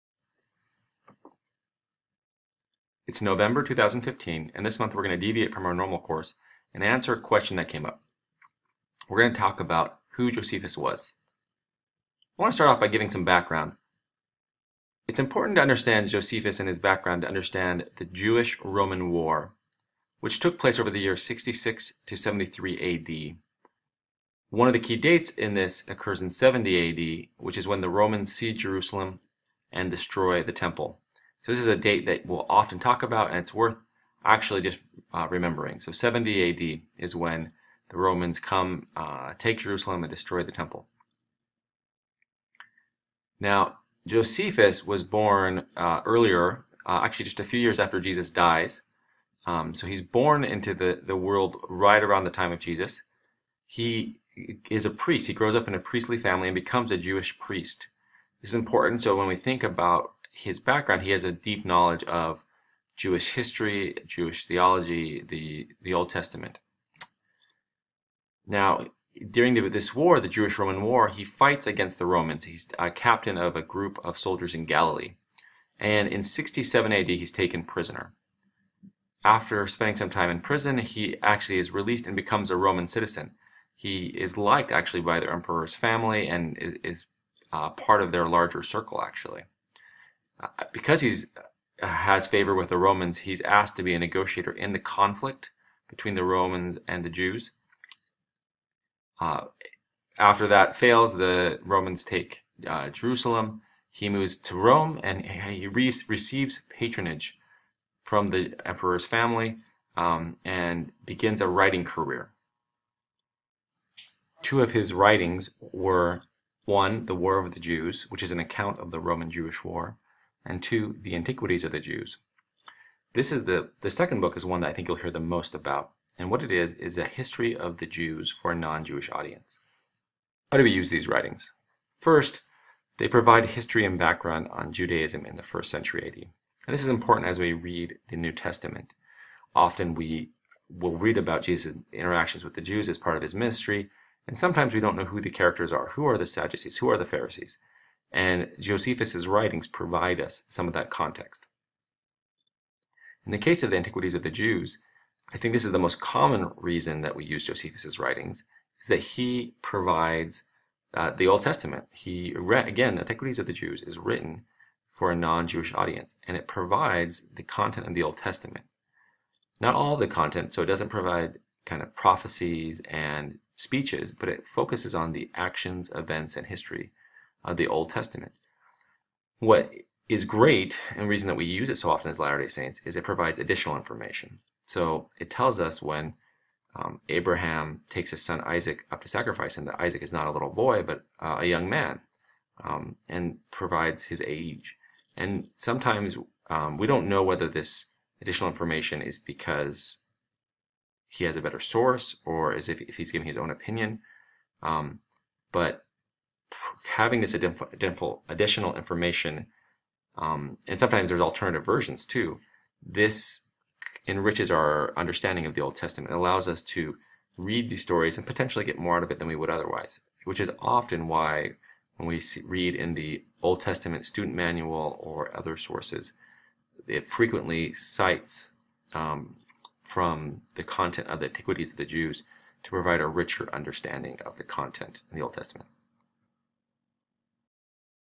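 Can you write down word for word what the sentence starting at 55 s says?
He grows up in a priestly family and becomes a Jewish priest.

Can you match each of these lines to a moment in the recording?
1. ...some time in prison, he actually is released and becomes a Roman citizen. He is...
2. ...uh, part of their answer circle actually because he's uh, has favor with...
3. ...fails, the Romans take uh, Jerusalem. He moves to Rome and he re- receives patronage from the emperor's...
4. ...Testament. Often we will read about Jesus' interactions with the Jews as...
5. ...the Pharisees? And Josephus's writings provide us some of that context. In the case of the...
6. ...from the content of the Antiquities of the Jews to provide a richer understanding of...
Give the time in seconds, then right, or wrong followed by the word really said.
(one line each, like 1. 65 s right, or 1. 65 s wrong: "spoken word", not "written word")
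1. 79 s right
2. 87 s wrong: "larger", not "answer"
3. 100 s right
4. 138 s right
5. 146 s right
6. 229 s right.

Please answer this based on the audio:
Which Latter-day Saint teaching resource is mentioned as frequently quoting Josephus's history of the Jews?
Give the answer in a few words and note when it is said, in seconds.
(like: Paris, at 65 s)
Old Testament student manual, at 223 s.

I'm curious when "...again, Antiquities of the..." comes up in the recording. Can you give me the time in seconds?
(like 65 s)
162 s.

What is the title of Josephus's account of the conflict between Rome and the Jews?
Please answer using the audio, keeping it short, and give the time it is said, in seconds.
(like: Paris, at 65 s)
The War of the Jews, at 117 s.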